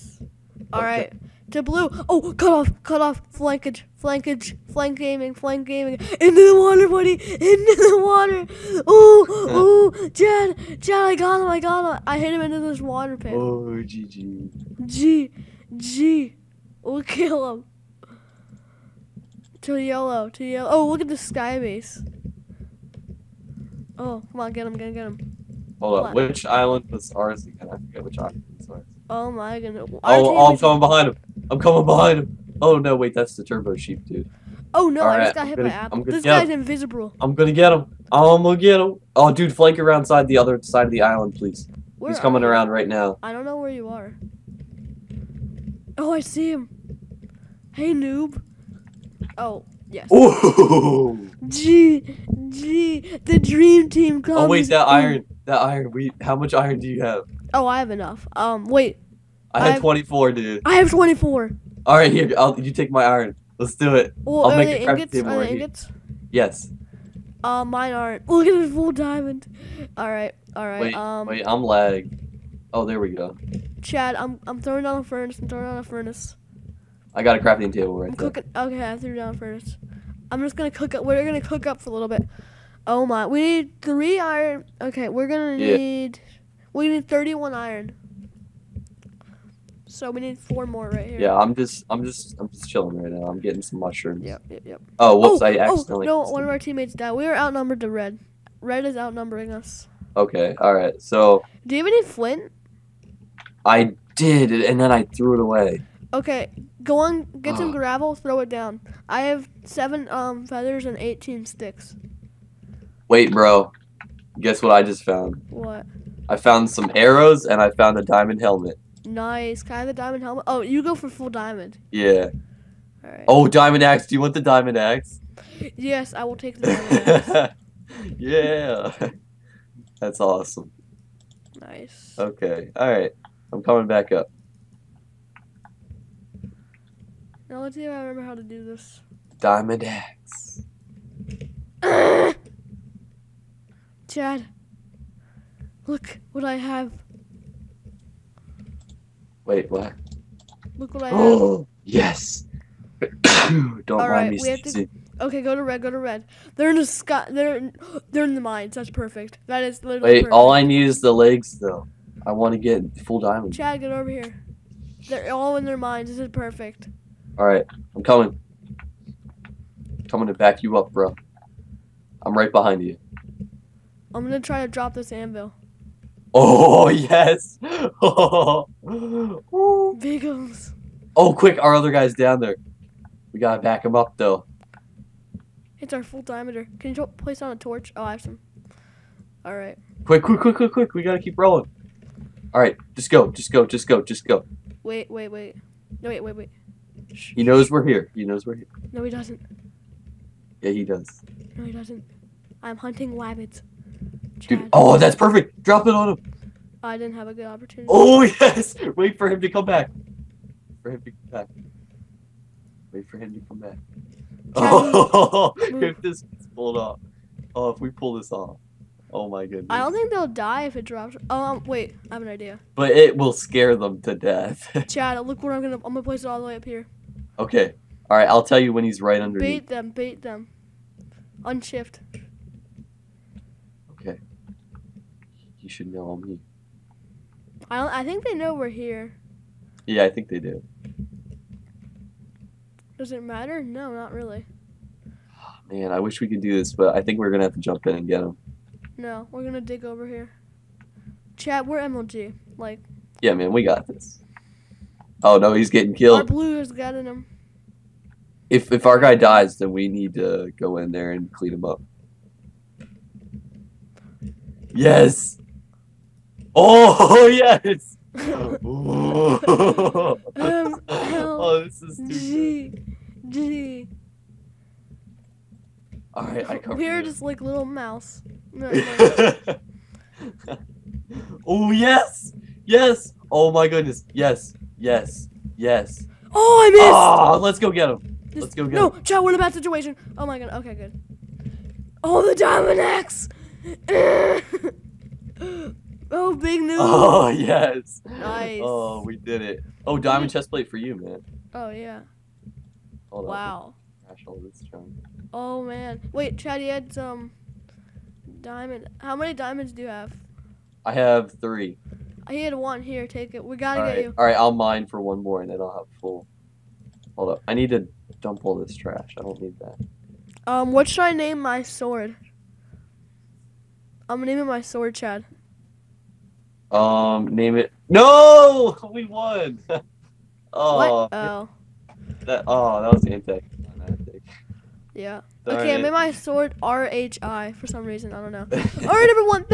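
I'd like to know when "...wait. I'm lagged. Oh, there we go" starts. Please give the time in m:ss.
1:11.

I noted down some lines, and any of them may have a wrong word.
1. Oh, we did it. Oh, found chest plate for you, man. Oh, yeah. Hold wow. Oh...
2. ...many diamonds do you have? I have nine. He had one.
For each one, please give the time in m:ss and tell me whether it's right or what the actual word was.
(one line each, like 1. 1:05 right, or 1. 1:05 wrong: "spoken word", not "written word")
1. 4:58 wrong: "diamond", not "found"
2. 5:09 wrong: "three", not "nine".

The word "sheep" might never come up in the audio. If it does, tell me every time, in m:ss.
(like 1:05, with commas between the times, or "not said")
0:33.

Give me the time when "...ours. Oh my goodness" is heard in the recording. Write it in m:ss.
0:28.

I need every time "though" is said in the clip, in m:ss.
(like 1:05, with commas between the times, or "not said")
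2:41, 3:04.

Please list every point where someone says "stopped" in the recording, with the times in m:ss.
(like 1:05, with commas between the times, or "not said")
not said.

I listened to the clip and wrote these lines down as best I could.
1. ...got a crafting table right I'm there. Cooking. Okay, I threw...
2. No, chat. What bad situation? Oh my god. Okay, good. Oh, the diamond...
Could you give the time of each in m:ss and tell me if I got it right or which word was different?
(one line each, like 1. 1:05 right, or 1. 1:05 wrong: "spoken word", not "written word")
1. 1:17 right
2. 4:48 right.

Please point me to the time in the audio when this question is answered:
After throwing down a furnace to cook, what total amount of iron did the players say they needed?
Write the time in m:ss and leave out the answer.
1:27.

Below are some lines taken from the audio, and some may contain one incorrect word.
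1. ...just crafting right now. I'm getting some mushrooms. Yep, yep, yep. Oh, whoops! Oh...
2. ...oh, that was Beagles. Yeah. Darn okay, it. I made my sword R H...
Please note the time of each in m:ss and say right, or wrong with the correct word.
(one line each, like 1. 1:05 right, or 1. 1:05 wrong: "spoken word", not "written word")
1. 1:32 wrong: "chilling", not "crafting"
2. 5:32 wrong: "Antec", not "Beagles".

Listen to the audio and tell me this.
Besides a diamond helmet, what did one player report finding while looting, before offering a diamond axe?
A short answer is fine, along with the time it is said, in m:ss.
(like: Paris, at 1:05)
Arrows, at 1:56.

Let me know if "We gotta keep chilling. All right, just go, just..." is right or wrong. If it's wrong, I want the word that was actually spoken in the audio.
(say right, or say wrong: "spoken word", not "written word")
wrong: "rolling", not "chilling".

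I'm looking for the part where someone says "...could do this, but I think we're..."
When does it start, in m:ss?
4:06.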